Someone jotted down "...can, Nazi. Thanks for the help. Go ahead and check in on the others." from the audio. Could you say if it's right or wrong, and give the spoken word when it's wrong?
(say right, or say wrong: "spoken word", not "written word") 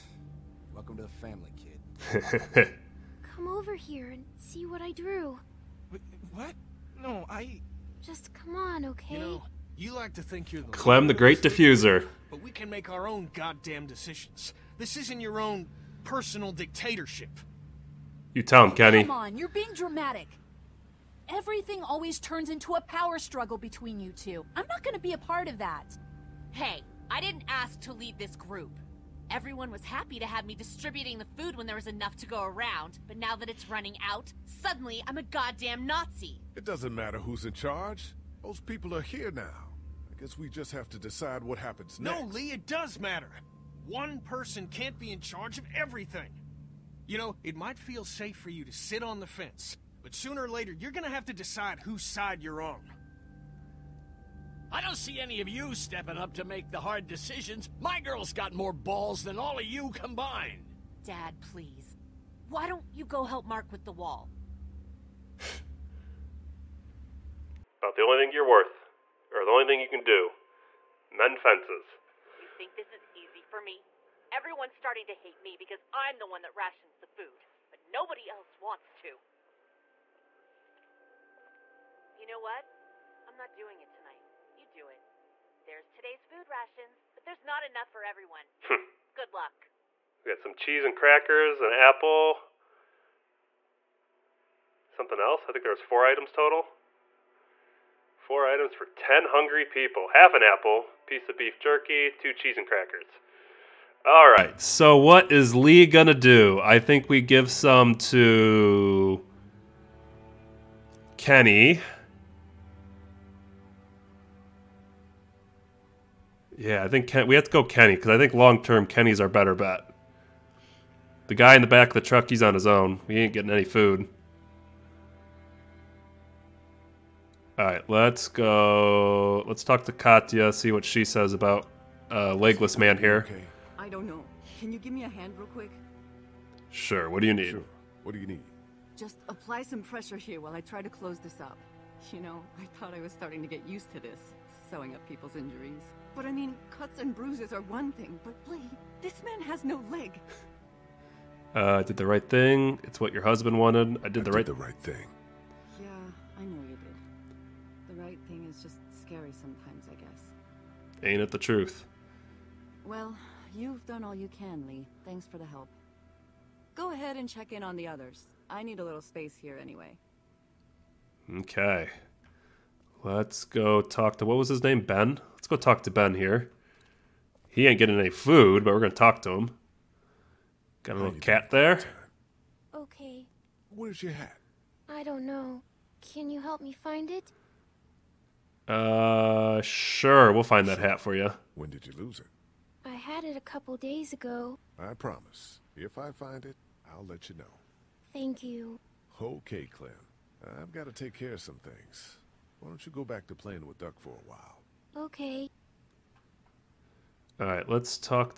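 wrong: "Lee", not "Nazi".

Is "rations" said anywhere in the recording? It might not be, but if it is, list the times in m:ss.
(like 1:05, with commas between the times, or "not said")
1:16, 1:26.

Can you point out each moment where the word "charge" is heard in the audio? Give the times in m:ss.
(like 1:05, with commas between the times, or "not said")
0:37, 0:45.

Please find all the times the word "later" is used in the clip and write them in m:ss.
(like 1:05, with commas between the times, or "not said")
0:50.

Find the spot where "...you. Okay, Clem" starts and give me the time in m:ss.
3:18.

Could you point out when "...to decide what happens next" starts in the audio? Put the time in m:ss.
0:40.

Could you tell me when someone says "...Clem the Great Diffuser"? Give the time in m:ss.
0:10.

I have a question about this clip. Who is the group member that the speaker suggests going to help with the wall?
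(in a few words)
Mark.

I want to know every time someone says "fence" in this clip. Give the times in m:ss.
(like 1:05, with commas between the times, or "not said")
0:49, 1:11.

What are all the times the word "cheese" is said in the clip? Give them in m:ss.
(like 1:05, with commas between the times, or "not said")
1:30, 1:42.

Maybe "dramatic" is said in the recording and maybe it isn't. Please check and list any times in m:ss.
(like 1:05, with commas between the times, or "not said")
0:19.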